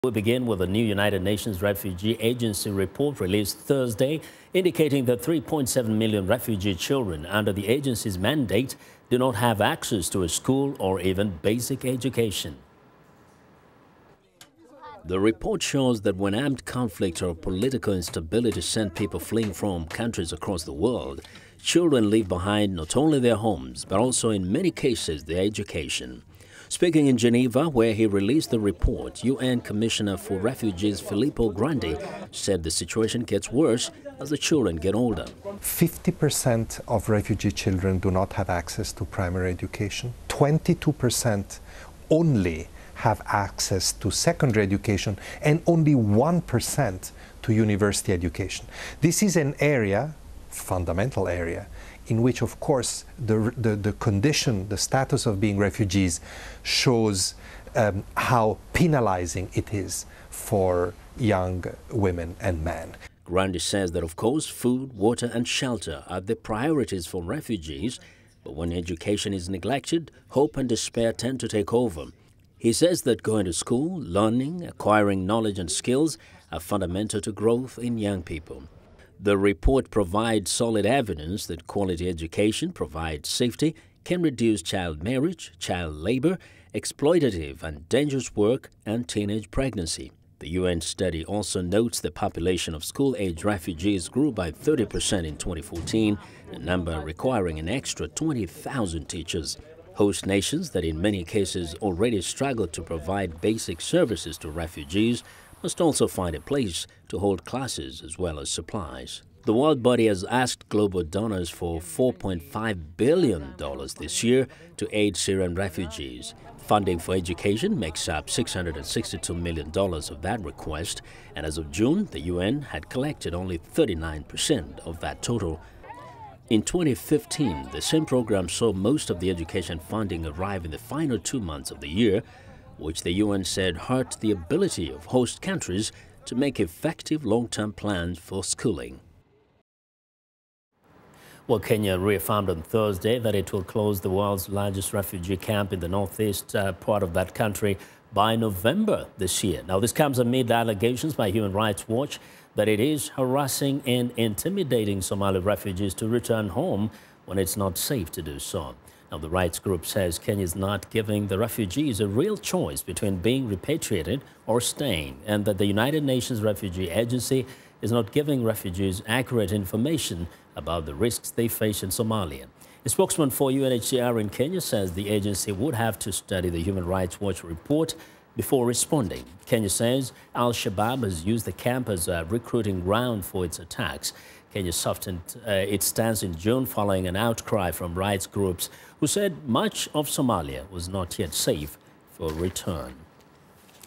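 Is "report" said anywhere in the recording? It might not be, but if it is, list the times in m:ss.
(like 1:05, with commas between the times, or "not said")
0:02, 0:15, 0:28, 1:19, 2:57.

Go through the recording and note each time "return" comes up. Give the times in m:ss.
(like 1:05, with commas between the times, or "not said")
2:36, 3:12.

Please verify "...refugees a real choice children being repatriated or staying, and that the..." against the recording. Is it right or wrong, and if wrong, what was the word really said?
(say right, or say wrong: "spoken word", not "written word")
wrong: "between", not "children".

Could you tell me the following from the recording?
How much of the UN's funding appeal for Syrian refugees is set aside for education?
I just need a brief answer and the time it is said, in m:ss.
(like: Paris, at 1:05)
$662 million, at 1:58.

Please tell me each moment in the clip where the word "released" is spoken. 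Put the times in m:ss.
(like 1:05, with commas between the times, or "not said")
0:03, 0:28.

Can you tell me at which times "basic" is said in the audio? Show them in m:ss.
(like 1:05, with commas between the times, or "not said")
0:11, 1:43.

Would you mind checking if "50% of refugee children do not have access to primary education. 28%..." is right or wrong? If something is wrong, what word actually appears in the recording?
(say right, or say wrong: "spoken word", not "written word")
wrong: "22", not "28".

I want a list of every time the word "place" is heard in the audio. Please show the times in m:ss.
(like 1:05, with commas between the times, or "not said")
1:46.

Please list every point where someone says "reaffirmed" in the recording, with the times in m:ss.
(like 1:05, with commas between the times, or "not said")
2:21.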